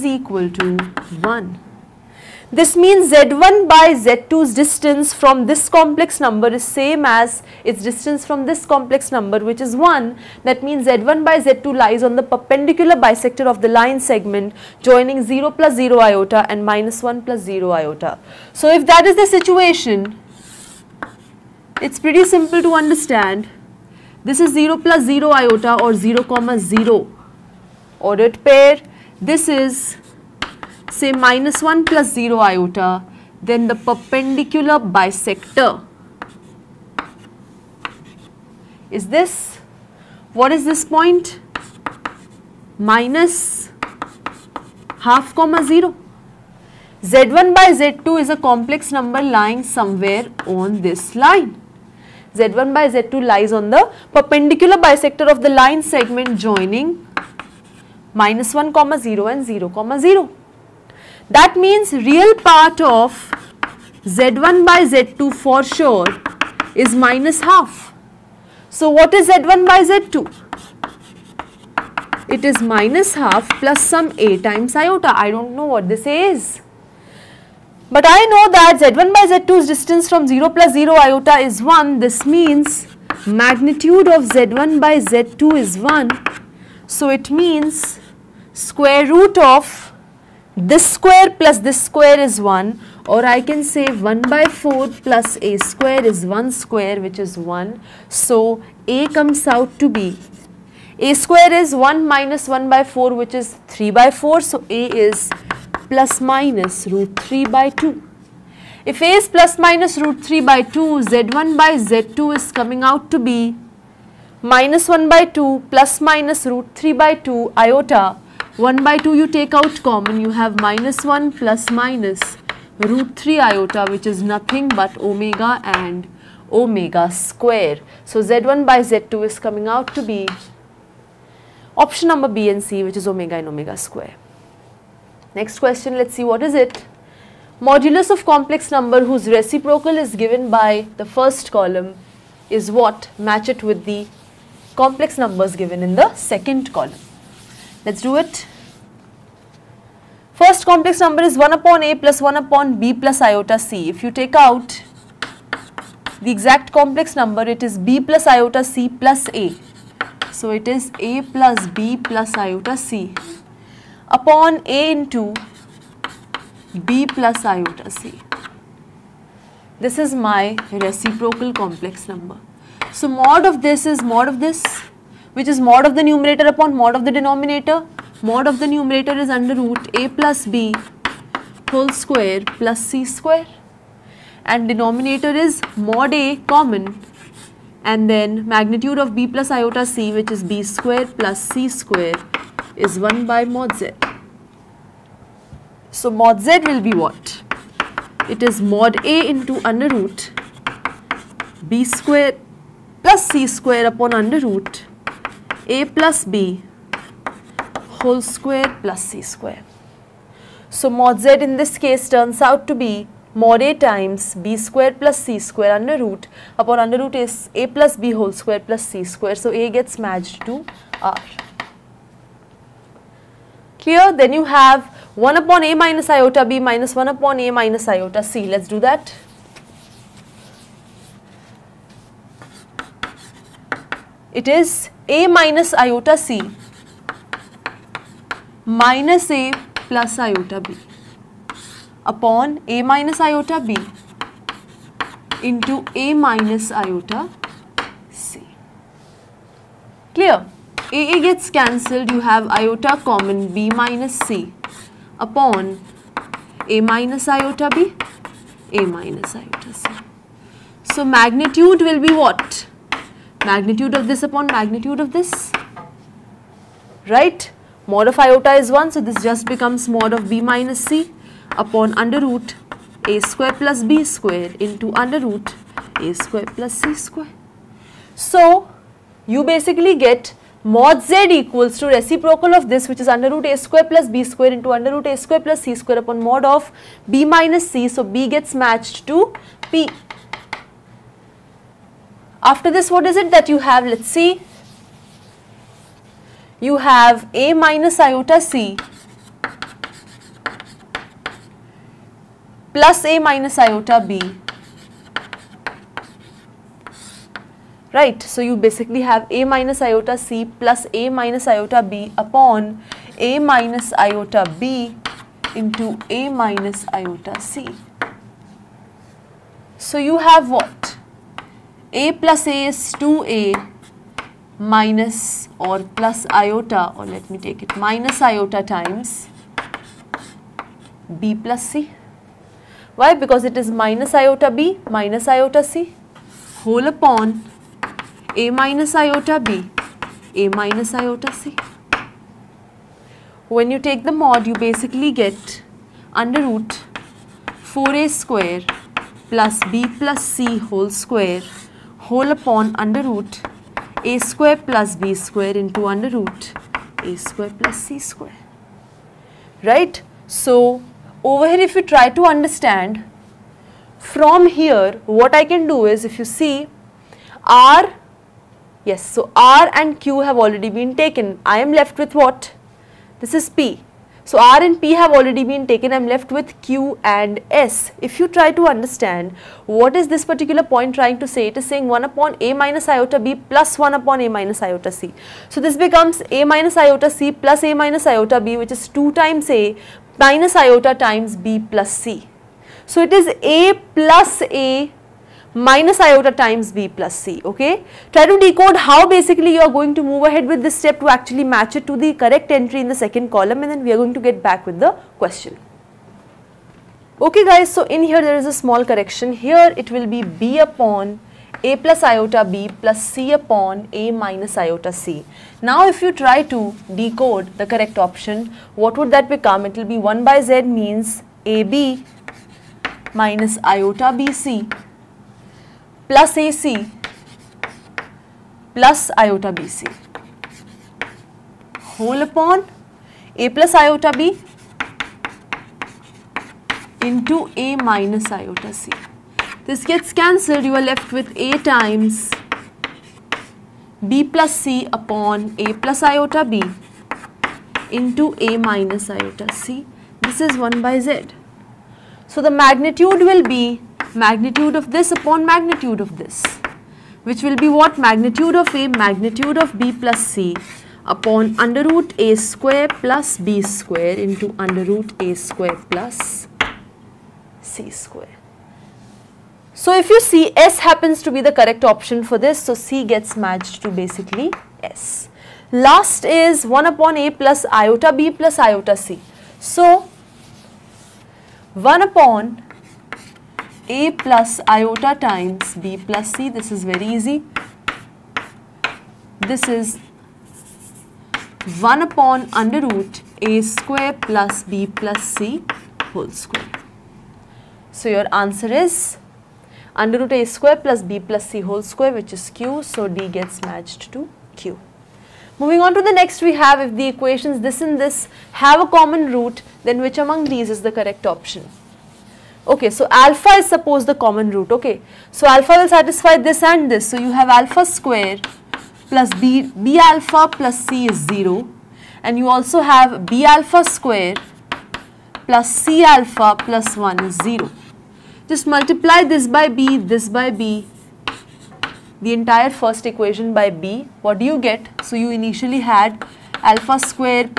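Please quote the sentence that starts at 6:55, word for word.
Now if you try to decode the correct option, what would that become?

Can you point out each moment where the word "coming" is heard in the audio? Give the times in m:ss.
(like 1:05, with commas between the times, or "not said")
1:52, 2:09.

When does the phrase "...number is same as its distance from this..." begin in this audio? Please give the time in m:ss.
0:06.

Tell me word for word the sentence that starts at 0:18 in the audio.
So, if that is the situation, it is pretty simple to understand.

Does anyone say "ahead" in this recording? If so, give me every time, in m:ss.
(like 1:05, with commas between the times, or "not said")
6:40.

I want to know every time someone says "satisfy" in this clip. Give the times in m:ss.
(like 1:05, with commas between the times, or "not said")
8:35.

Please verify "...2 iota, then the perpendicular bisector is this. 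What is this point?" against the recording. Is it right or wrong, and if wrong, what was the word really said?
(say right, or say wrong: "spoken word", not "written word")
wrong: "0", not "2".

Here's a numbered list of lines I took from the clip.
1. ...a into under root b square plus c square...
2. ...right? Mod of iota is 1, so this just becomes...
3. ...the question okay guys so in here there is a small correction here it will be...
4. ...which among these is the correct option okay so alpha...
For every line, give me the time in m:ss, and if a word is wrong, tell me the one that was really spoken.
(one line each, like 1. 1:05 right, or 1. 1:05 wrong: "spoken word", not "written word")
1. 3:19 right
2. 4:27 right
3. 6:44 right
4. 8:30 right.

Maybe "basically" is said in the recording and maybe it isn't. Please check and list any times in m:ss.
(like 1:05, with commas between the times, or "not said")
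4:39, 5:08, 5:44, 6:39, 7:53.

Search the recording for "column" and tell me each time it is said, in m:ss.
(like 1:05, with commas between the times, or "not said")
2:21, 2:26, 6:43.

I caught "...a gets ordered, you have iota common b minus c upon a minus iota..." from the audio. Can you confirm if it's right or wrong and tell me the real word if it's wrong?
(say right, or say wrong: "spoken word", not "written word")
wrong: "cancelled", not "ordered".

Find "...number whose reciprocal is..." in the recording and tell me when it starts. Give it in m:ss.
2:18.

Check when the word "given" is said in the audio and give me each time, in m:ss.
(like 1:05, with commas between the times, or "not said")
2:20, 2:25.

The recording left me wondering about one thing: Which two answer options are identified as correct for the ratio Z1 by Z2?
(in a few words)
B and C.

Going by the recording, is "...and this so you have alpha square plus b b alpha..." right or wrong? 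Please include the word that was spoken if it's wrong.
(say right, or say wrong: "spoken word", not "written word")
right.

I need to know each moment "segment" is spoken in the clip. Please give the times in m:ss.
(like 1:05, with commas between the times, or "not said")
0:14, 0:55.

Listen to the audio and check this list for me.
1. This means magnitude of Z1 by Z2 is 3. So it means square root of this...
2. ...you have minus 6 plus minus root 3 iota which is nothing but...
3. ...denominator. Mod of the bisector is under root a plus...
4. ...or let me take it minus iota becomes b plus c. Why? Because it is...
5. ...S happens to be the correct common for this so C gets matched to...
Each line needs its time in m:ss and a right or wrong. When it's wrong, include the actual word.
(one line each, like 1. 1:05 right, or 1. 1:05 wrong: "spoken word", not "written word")
1. 1:21 wrong: "1", not "3"
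2. 2:00 wrong: "1", not "6"
3. 2:57 wrong: "numerator", not "bisector"
4. 5:26 wrong: "times", not "becomes"
5. 7:50 wrong: "option", not "common".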